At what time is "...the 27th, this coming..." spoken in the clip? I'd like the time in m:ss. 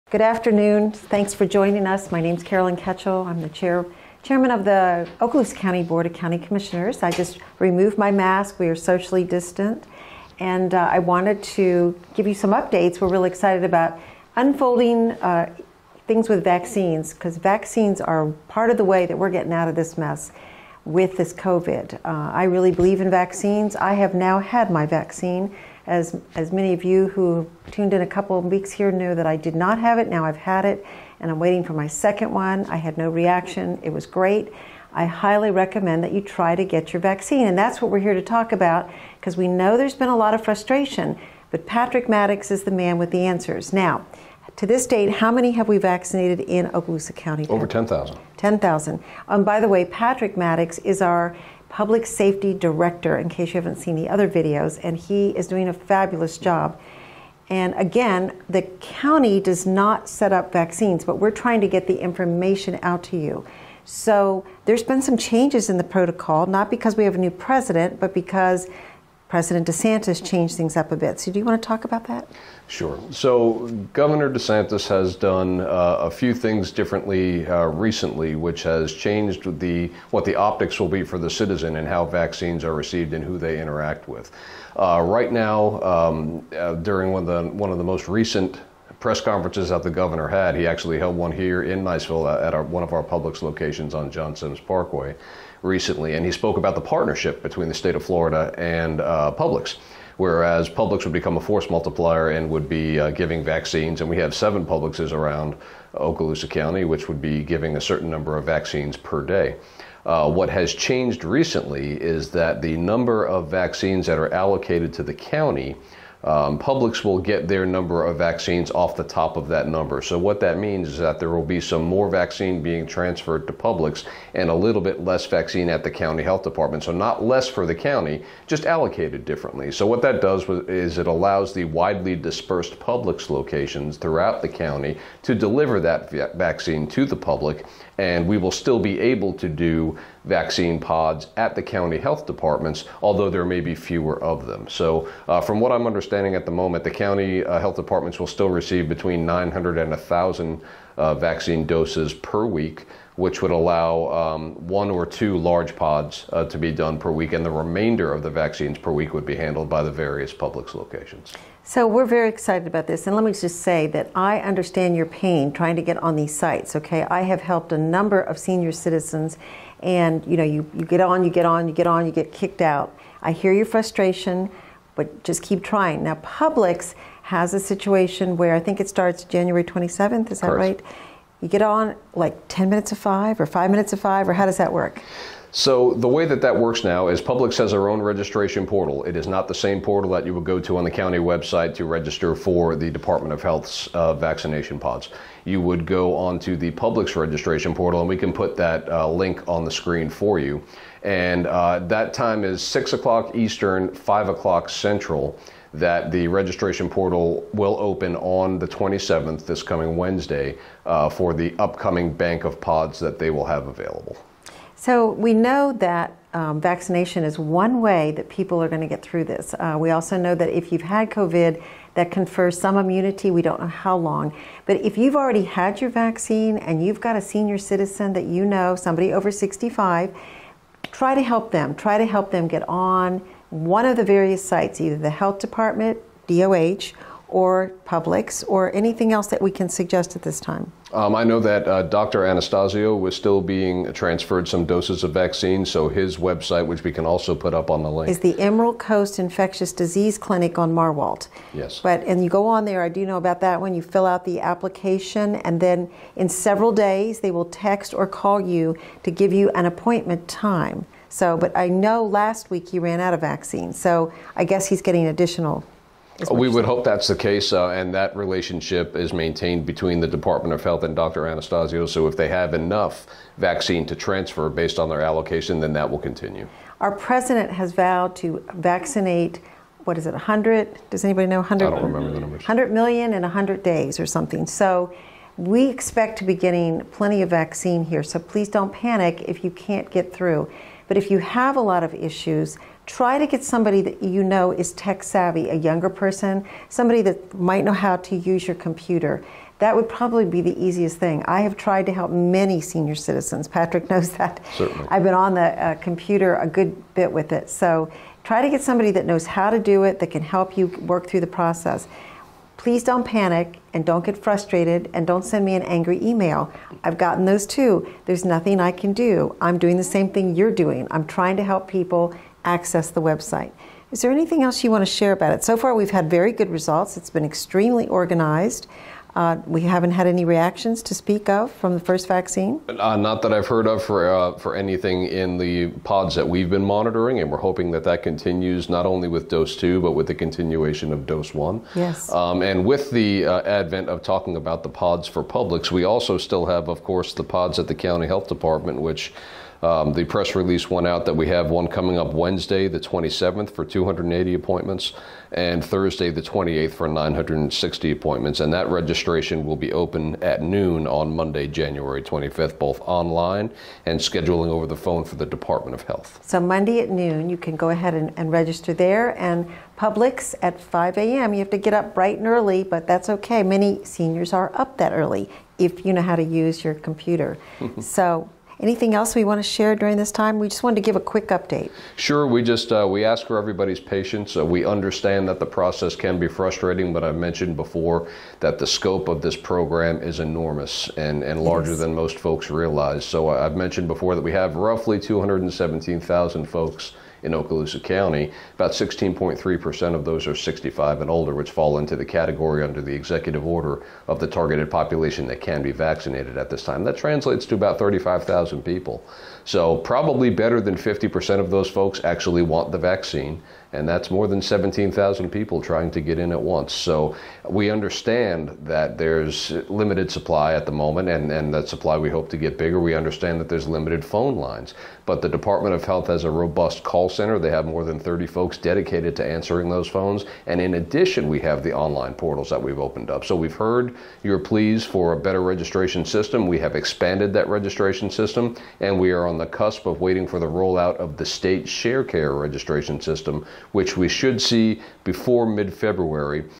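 3:28.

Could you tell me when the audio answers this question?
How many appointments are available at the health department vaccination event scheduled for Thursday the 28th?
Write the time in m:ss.
5:56.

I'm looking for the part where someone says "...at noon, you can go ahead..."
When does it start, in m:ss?
6:06.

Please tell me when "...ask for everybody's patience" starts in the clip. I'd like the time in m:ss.
6:23.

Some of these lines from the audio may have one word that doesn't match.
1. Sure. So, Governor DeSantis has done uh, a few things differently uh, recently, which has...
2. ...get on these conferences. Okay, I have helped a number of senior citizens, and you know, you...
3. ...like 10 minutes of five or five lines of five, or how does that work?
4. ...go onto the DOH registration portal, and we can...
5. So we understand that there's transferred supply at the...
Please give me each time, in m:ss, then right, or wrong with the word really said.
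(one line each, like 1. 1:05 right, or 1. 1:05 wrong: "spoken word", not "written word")
1. 1:12 right
2. 2:45 wrong: "sites", not "conferences"
3. 3:02 wrong: "minutes", not "lines"
4. 3:15 wrong: "Publix", not "DOH"
5. 6:56 wrong: "limited", not "transferred".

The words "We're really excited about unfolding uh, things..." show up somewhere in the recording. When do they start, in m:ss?
0:12.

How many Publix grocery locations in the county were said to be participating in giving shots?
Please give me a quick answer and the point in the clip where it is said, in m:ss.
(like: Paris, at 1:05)
7, at 1:44.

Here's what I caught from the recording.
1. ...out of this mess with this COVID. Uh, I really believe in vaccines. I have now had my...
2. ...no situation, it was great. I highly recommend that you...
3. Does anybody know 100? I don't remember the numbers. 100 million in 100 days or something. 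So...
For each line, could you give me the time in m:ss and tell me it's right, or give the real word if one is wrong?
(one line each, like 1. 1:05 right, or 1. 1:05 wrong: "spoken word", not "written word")
1. 0:19 right
2. 0:32 wrong: "reaction", not "situation"
3. 4:40 right.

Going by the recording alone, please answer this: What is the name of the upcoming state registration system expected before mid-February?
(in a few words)
Sharecare.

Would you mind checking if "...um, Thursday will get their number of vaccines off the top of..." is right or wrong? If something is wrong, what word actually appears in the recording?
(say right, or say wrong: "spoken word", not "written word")
wrong: "Publix", not "Thursday".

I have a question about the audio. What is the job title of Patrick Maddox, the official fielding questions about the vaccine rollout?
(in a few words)
Public safety director.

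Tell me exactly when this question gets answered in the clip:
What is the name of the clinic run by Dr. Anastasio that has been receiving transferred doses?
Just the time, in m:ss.
4:08.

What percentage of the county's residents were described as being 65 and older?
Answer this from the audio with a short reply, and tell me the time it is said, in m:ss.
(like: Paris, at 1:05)
16.3%, at 6:38.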